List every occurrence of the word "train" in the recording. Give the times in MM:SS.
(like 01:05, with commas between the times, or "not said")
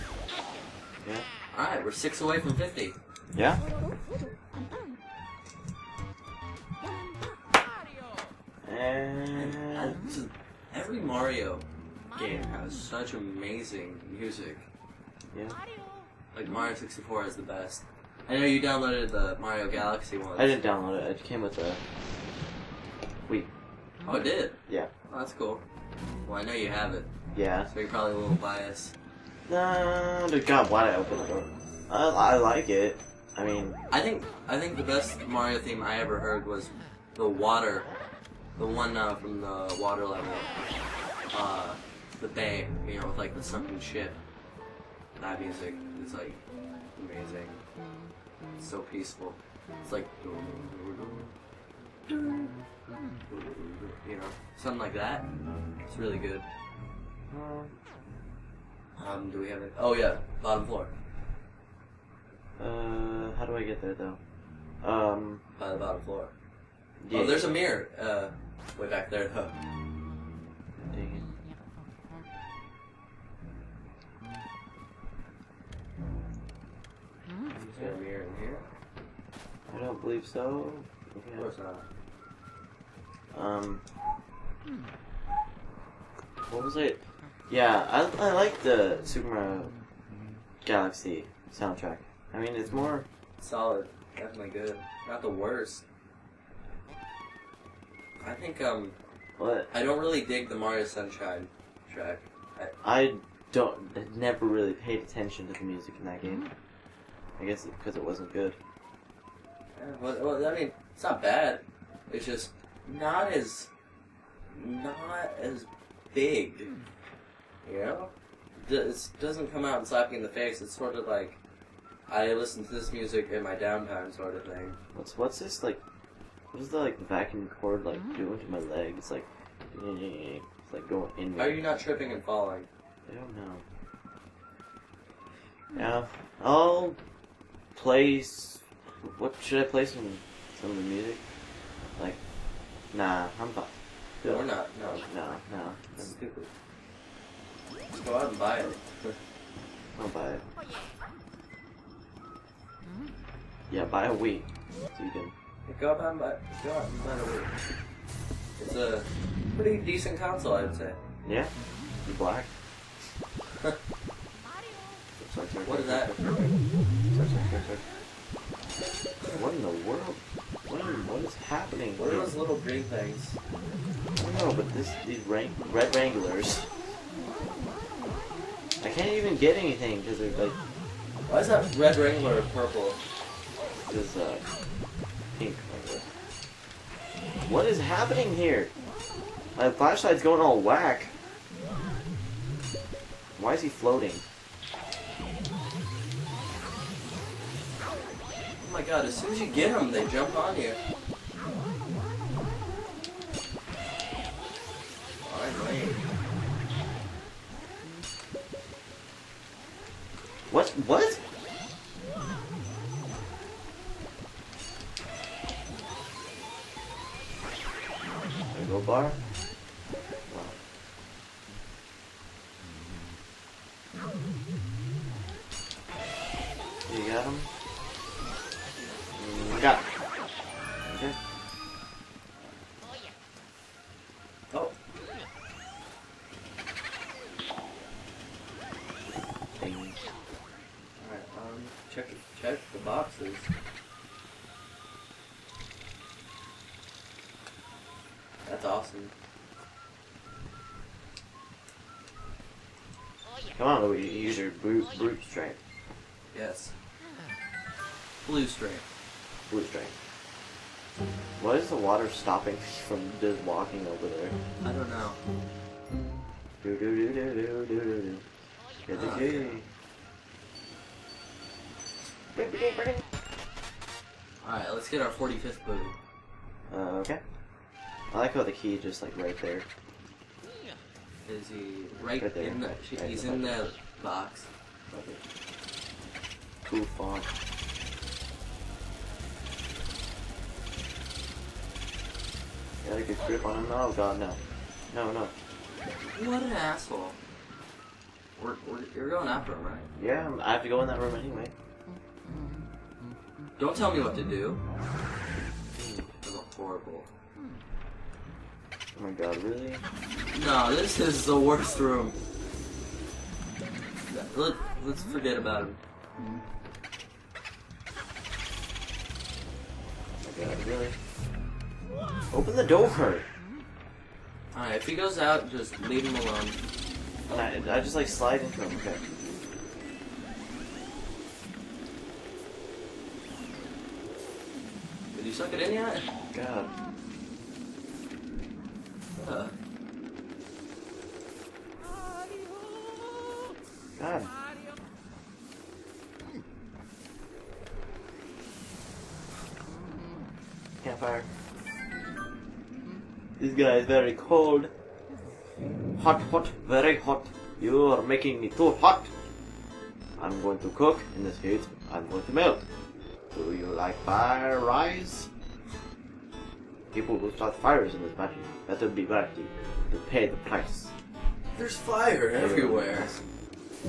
not said.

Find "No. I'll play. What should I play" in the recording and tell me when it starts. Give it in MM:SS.
02:15.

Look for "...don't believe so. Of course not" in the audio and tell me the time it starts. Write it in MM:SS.
01:19.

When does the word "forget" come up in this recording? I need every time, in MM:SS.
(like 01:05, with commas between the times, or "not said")
05:15.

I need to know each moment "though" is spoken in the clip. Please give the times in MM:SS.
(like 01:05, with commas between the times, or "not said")
01:03, 01:09.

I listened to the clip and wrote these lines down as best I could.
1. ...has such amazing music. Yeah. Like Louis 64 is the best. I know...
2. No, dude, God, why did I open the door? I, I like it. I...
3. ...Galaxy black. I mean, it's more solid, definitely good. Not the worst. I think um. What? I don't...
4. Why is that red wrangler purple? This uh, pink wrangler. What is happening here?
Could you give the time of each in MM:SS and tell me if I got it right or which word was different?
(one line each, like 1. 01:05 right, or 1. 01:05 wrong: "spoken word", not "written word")
1. 00:12 wrong: "Mario", not "Louis"
2. 00:29 right
3. 01:30 wrong: "soundtrack", not "black"
4. 03:01 right.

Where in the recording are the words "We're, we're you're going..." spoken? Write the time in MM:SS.
04:58.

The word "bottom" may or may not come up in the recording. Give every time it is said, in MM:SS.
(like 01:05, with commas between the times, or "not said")
01:00, 01:05.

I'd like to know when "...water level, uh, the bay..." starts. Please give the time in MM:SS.
00:39.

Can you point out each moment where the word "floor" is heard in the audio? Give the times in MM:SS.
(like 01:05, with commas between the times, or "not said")
01:00, 01:06.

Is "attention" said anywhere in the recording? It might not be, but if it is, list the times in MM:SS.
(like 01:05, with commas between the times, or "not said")
01:44.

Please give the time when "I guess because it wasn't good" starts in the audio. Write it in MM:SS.
01:47.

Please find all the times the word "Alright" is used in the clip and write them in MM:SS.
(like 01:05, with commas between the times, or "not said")
04:34, 05:24.